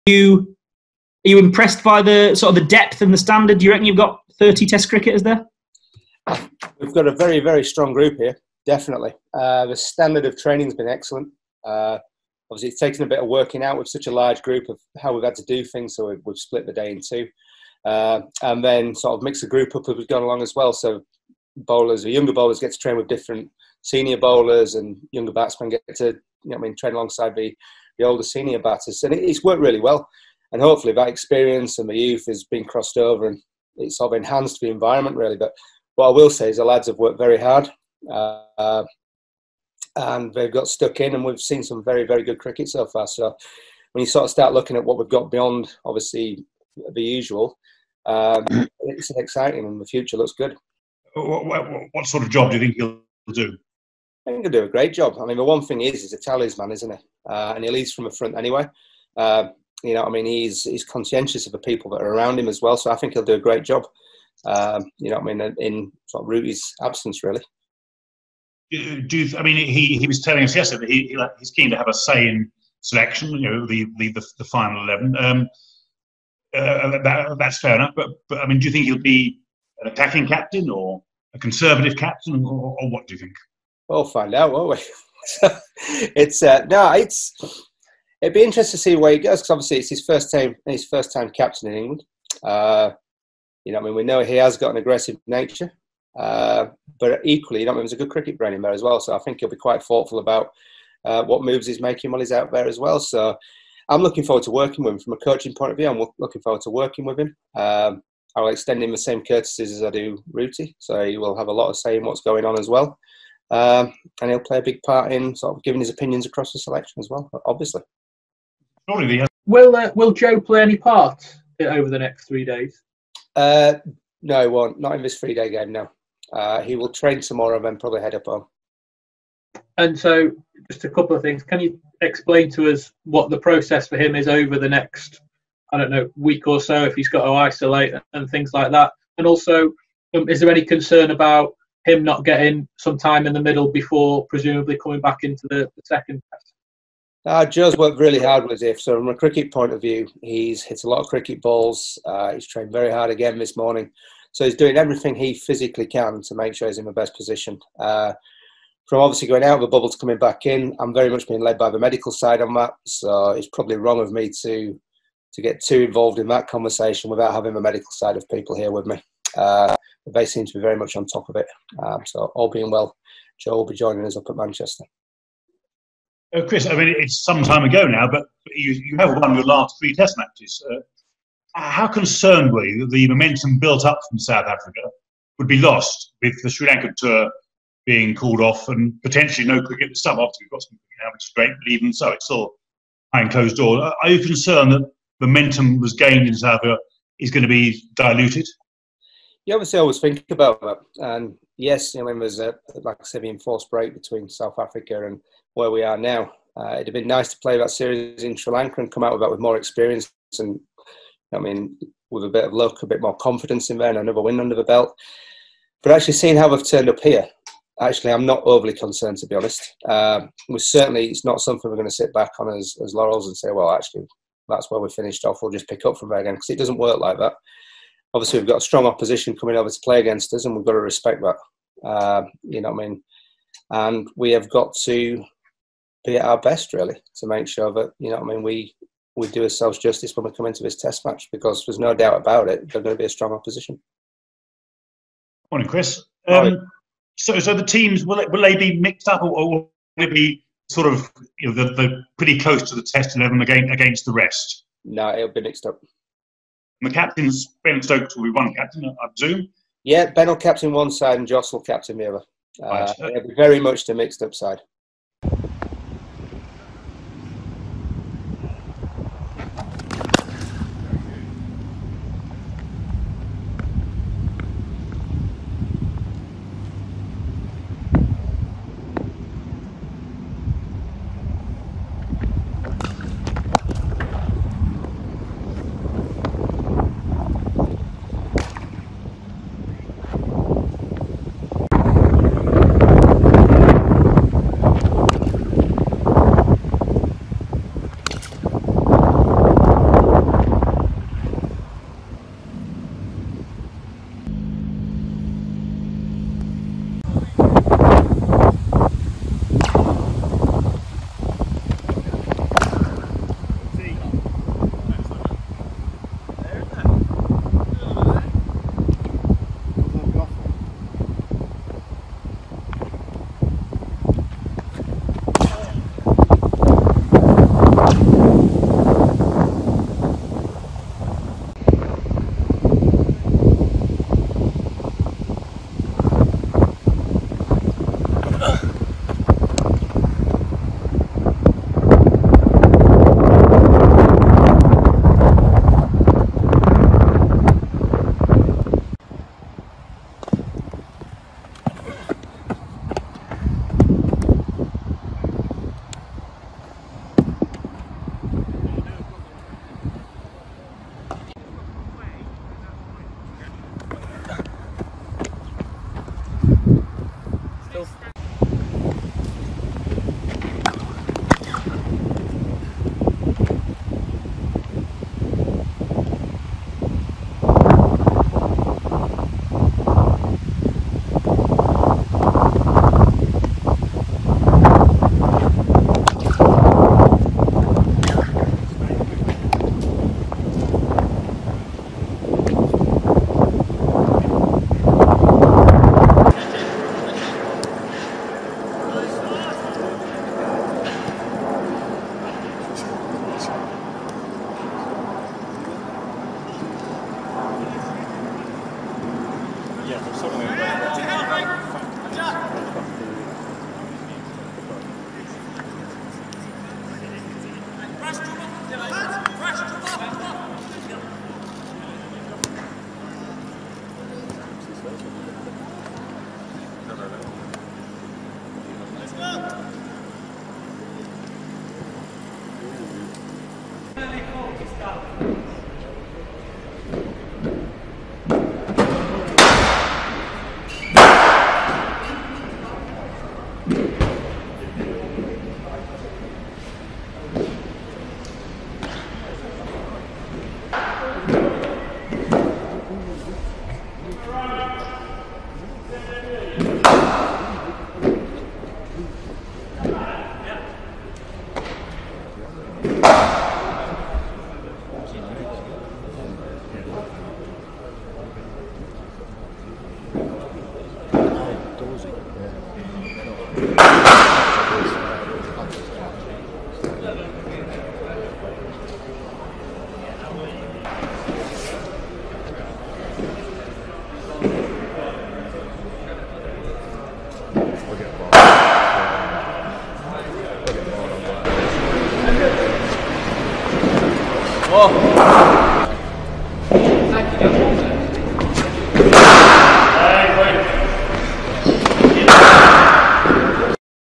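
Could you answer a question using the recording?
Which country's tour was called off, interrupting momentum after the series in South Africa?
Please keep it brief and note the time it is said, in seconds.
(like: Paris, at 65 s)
Sri Lanka, at 186 s.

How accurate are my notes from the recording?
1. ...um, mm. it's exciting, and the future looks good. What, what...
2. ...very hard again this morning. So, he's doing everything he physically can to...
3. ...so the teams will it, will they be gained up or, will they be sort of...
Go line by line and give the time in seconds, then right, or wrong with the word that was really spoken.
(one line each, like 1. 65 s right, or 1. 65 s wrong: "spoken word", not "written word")
1. 48 s right
2. 152 s right
3. 247 s wrong: "mixed", not "gained".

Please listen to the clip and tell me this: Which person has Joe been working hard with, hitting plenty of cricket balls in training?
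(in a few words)
Ziff.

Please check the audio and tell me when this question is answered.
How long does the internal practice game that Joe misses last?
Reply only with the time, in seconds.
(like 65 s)
125 s.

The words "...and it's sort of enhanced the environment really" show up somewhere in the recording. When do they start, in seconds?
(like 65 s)
33 s.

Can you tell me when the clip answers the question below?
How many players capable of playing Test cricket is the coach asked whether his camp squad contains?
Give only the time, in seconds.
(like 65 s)
4 s.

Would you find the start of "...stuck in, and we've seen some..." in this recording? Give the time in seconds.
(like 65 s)
40 s.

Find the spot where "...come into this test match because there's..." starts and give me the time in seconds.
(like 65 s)
240 s.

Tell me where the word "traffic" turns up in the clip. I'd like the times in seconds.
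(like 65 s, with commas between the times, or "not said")
not said.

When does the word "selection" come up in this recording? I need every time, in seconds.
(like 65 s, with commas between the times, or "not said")
72 s, 116 s.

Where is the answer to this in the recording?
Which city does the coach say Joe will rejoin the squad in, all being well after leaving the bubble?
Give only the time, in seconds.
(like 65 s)
174 s.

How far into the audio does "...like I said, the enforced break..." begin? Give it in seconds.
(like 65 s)
202 s.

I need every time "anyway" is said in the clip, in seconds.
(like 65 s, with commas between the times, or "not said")
58 s.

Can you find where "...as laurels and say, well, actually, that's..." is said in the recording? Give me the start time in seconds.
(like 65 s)
222 s.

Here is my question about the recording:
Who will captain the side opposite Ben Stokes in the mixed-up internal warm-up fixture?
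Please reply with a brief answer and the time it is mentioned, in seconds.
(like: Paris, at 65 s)
Joss, at 261 s.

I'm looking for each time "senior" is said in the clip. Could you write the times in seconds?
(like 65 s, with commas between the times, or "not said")
23 s, 28 s.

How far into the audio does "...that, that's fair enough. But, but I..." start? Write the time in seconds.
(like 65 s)
77 s.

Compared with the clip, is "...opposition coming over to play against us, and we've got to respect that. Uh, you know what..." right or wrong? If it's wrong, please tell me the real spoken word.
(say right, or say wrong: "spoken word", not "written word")
right.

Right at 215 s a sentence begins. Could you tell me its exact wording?
But actually, seeing how they've turned up here, actually, I'm not overly concerned to be honest.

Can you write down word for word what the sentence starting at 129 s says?
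And so, just a couple of things.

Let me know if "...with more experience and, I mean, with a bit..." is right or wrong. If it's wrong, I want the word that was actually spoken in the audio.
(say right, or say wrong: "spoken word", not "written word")
right.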